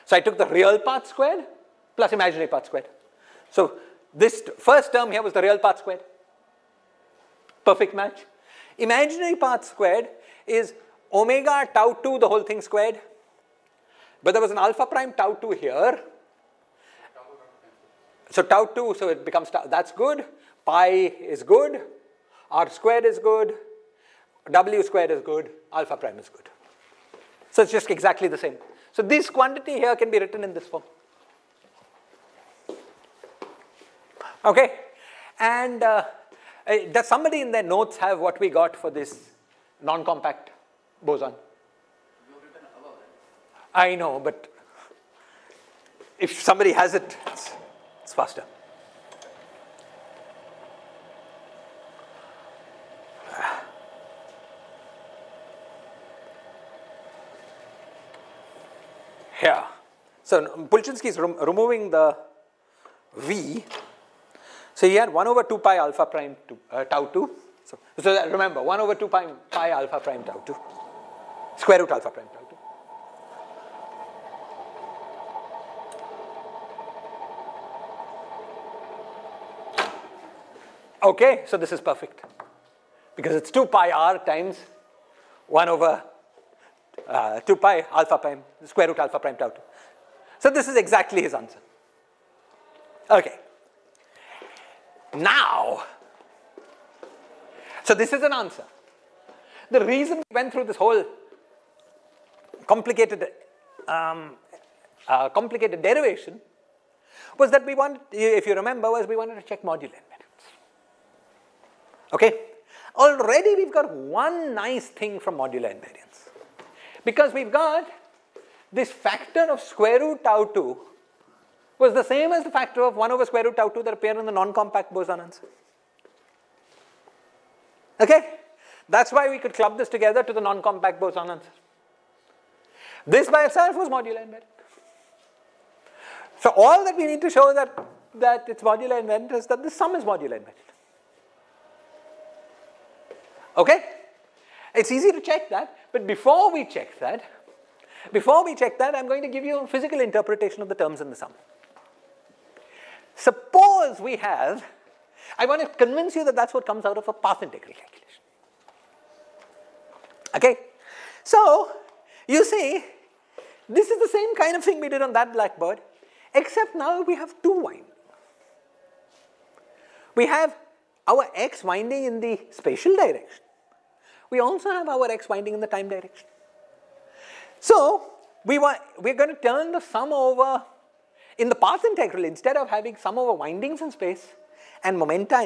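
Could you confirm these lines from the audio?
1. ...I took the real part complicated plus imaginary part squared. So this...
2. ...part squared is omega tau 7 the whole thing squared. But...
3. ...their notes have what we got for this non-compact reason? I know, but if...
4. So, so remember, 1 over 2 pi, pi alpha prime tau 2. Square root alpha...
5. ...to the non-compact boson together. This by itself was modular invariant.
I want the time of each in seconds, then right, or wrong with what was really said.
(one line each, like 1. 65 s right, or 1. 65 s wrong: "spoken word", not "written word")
1. 0 s wrong: "squared", not "complicated"
2. 9 s wrong: "2", not "7"
3. 37 s wrong: "boson", not "reason"
4. 67 s right
5. 130 s wrong: "answer", not "together".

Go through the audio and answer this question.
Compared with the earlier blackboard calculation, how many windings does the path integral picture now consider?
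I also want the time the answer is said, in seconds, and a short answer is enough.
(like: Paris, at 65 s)
2, at 167 s.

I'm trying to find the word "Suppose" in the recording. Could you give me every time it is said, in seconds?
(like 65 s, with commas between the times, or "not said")
153 s.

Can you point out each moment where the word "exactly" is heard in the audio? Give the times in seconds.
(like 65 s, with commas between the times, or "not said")
27 s, 90 s.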